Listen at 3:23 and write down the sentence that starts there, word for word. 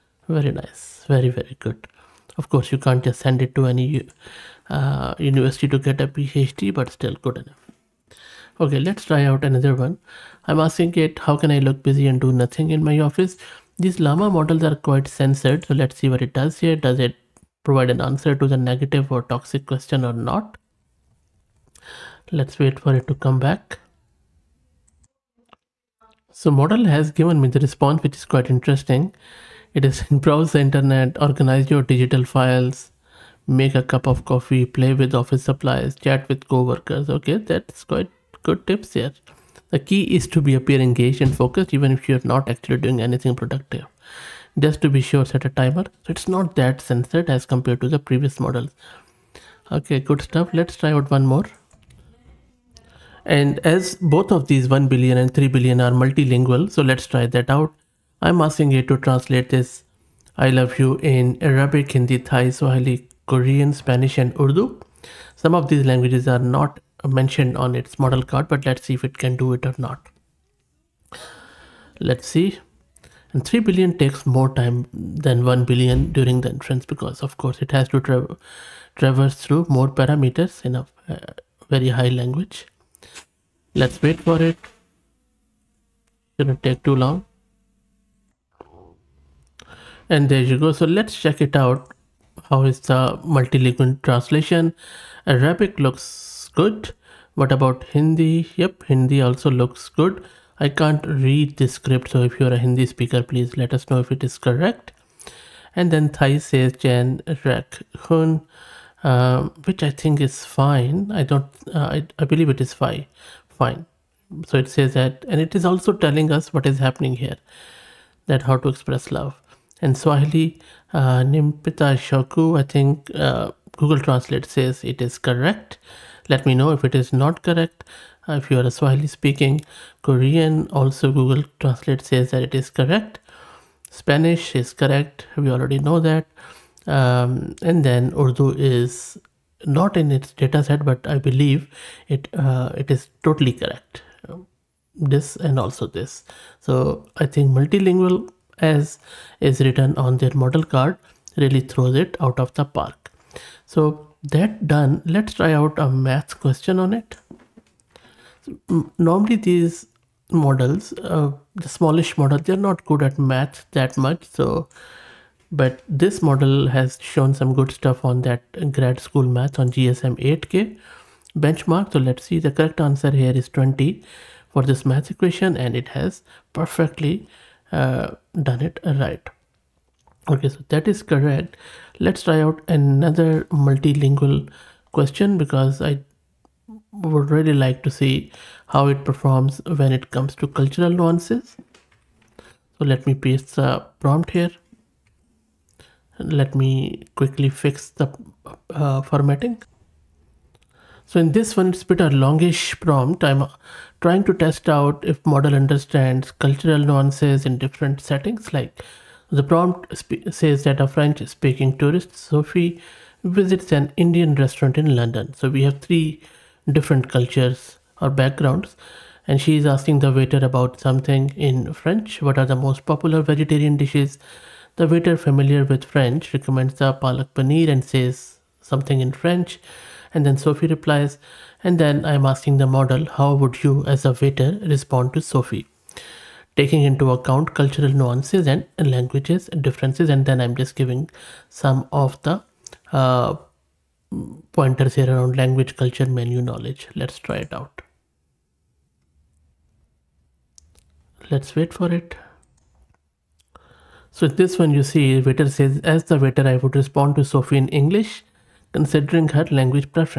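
I'm trying to test out if model understands cultural nuances in different settings.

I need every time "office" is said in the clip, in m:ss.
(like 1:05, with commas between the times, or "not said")
0:13, 0:35.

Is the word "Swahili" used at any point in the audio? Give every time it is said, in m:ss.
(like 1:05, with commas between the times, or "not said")
1:02, 1:59, 2:08.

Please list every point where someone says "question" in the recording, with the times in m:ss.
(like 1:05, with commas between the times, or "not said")
0:19, 2:36, 3:04.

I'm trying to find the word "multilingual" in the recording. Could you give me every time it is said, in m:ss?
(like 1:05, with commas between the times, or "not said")
0:55, 1:33, 2:27, 3:03.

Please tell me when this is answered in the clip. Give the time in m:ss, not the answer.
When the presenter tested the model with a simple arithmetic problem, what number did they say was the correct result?
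2:53.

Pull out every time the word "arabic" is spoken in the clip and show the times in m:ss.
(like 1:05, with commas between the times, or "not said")
1:01, 1:35.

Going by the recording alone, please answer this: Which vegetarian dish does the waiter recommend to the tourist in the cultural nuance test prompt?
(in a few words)
palak paneer.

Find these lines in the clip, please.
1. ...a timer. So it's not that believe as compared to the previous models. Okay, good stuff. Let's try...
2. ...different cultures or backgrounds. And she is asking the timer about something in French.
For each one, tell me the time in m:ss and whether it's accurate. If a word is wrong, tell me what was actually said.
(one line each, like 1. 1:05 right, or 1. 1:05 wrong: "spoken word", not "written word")
1. 0:45 wrong: "sensitive", not "believe"
2. 3:36 wrong: "waiter", not "timer".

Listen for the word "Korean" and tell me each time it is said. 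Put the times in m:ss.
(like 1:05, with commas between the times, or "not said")
1:03, 2:10.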